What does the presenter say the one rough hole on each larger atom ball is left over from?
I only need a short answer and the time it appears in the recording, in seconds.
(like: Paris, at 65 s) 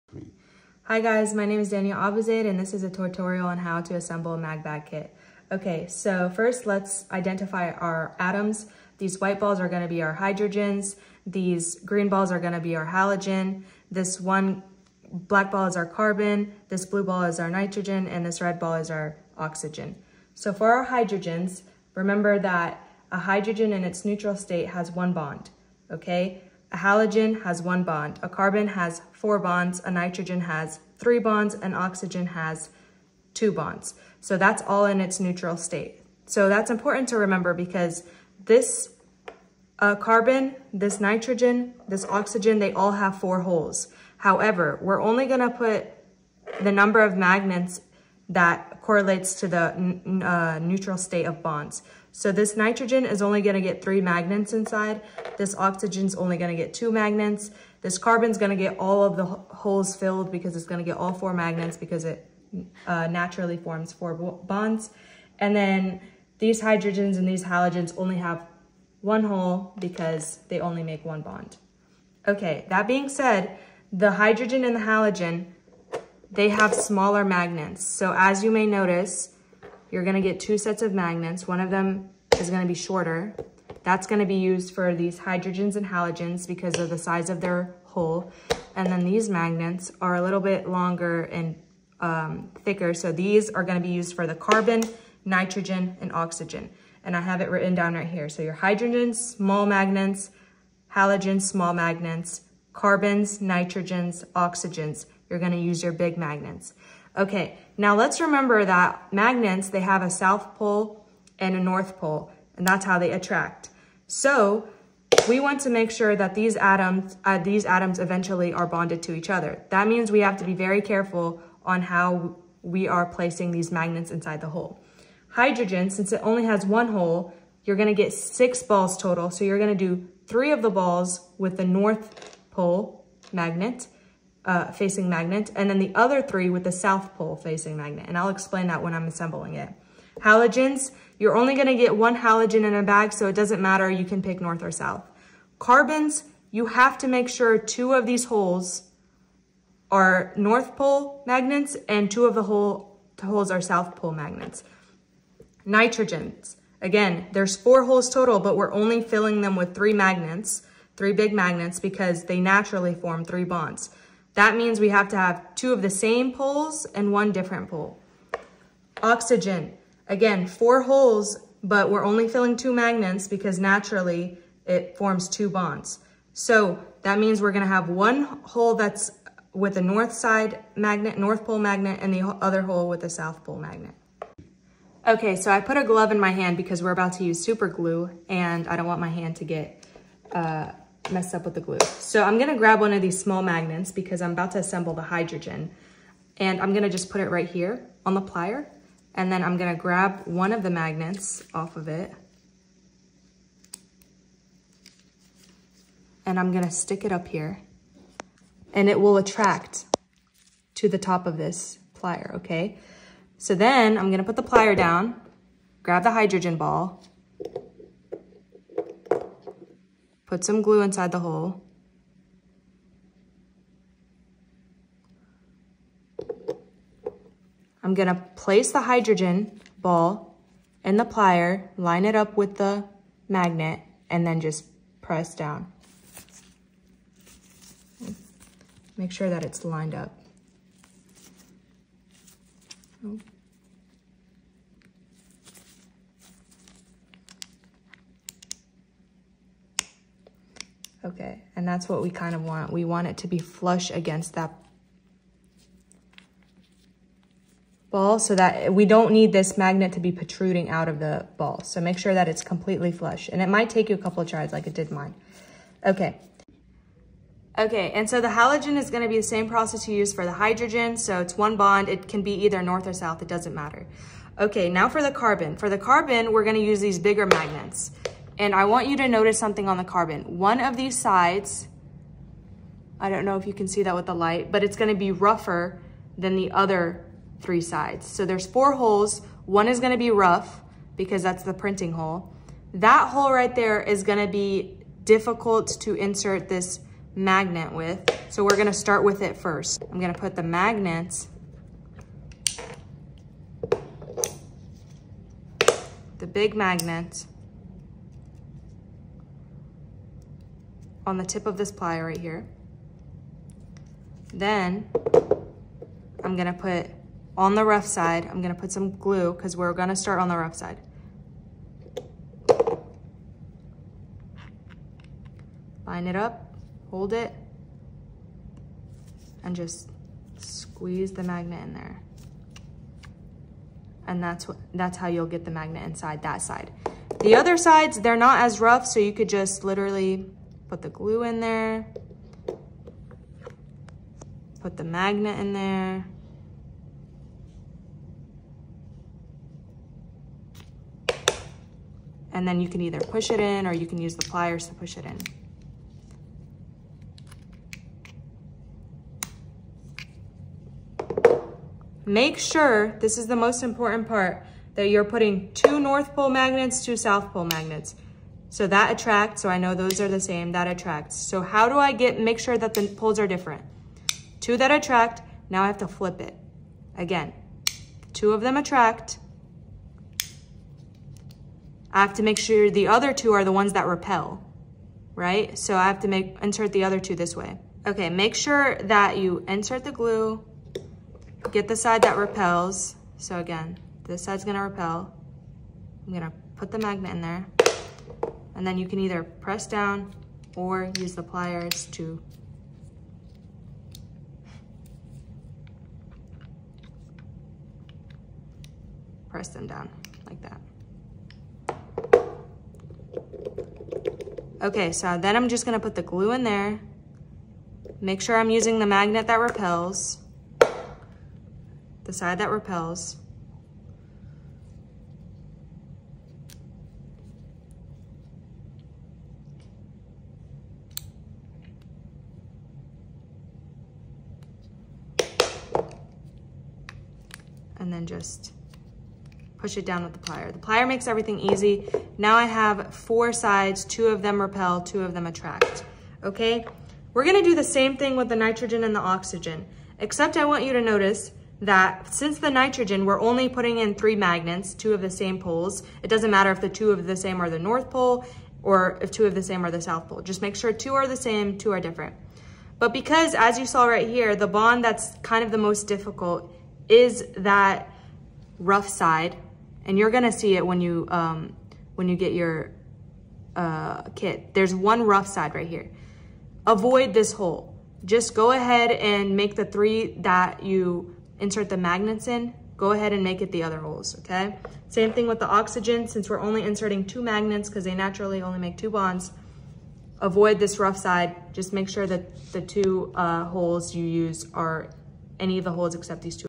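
Printing, at 291 s.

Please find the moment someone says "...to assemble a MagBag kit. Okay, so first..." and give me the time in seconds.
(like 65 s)
3 s.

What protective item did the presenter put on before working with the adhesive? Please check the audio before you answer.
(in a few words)
A glove.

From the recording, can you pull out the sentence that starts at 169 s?
Oxygen, again, four holes, but we're only filling two magnets because naturally it forms two bonds.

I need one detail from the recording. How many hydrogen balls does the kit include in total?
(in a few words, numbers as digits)
6.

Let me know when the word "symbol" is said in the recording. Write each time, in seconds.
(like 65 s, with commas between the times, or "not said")
not said.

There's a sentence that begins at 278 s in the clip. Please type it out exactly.
And I want you to notice something on the carbon.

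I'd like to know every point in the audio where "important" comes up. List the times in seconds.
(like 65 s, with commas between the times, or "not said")
36 s, 363 s.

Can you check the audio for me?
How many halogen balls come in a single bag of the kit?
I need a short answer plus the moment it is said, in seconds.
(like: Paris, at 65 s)
1, at 141 s.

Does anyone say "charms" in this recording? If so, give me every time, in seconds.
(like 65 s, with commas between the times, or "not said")
not said.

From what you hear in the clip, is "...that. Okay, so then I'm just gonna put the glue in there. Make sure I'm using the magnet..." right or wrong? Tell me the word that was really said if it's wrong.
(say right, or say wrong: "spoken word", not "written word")
right.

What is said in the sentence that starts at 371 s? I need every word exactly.
So how do I get, make sure that the poles are different?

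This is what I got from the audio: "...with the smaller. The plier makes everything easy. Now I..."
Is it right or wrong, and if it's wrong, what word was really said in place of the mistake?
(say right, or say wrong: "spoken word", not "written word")
wrong: "plier", not "smaller".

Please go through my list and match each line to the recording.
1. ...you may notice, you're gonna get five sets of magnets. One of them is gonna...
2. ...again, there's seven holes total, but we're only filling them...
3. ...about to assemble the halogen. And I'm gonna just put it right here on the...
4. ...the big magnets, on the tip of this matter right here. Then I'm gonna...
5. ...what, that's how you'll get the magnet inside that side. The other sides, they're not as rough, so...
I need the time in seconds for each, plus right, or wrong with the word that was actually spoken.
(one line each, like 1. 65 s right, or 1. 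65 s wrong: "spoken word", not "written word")
1. 78 s wrong: "two", not "five"
2. 156 s wrong: "four", not "seven"
3. 194 s wrong: "hydrogen", not "halogen"
4. 306 s wrong: "plier", not "matter"
5. 334 s right.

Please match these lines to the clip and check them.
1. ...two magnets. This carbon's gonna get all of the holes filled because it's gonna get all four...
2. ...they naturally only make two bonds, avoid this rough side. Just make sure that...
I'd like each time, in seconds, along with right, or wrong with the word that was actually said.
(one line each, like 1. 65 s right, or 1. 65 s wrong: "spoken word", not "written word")
1. 56 s right
2. 487 s right.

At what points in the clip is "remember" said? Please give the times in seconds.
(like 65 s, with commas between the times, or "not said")
21 s, 37 s, 108 s.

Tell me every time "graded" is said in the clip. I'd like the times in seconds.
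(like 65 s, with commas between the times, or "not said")
not said.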